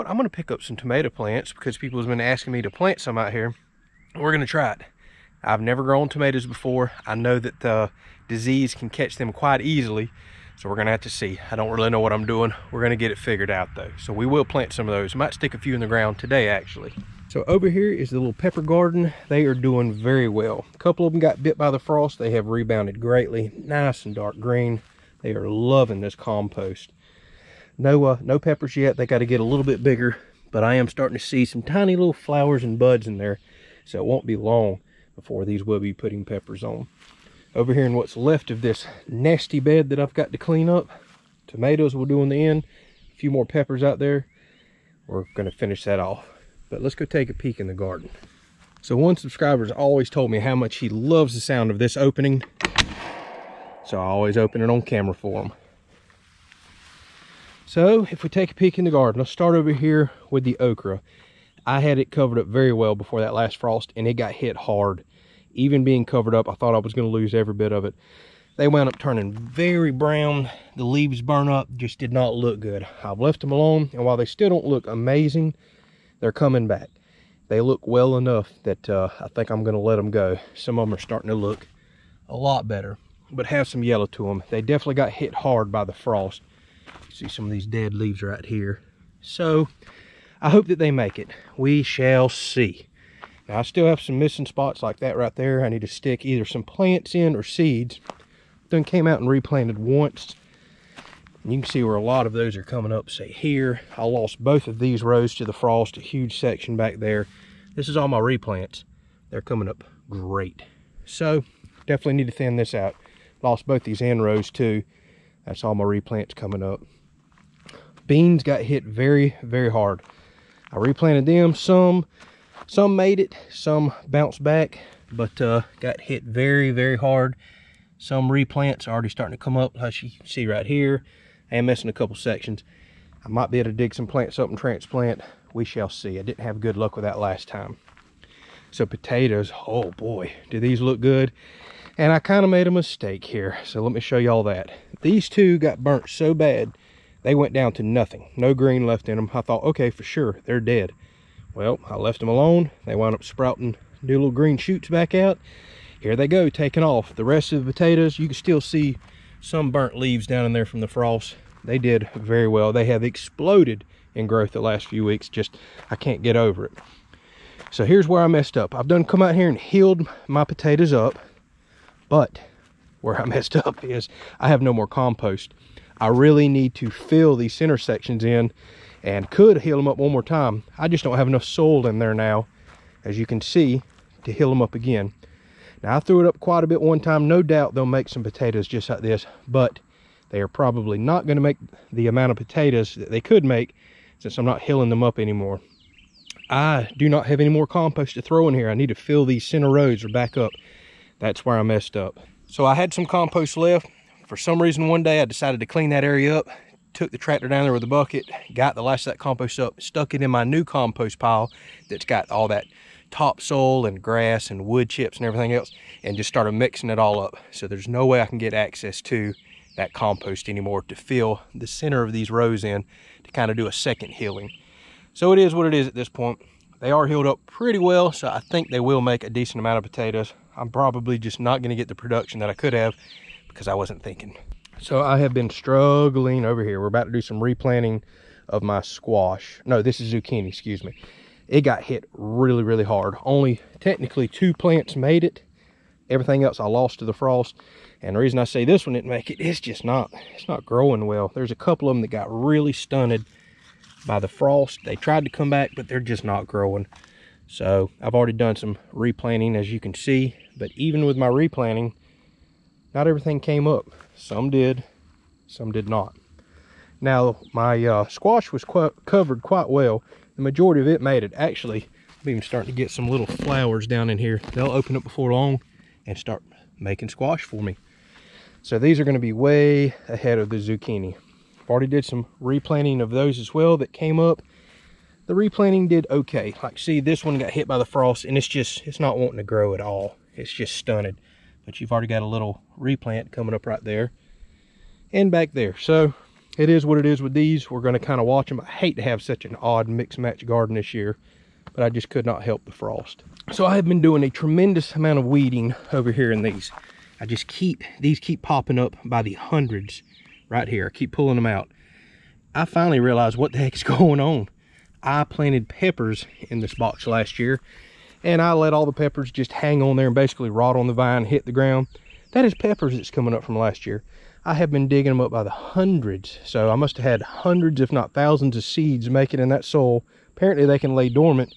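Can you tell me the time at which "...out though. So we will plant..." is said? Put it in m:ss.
0:13.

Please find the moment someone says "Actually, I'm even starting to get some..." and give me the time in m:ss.
4:31.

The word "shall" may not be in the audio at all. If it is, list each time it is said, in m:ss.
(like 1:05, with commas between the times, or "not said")
1:31, 2:15.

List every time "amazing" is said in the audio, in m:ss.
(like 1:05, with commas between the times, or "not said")
1:14.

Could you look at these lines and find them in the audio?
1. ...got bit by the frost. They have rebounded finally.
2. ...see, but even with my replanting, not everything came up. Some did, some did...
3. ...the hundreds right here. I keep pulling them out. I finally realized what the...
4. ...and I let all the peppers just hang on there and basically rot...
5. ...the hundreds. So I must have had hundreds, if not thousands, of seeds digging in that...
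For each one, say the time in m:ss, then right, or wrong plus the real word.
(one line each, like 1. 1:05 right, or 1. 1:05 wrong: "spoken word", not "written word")
1. 0:21 wrong: "greatly", not "finally"
2. 4:19 right
3. 5:09 right
4. 5:18 right
5. 5:25 wrong: "making", not "digging".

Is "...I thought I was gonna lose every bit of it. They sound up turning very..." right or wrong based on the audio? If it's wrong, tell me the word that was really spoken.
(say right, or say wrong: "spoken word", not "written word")
wrong: "wound", not "sound".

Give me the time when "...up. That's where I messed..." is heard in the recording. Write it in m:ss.
3:20.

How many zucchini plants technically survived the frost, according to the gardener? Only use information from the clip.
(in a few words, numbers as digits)
2.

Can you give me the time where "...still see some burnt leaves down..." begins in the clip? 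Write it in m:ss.
2:38.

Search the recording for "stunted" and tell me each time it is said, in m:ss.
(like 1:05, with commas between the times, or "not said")
4:12, 4:50.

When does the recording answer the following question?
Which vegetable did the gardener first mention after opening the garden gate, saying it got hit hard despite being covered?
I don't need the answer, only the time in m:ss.
1:00.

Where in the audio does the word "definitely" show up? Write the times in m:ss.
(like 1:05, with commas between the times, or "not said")
1:24, 1:51.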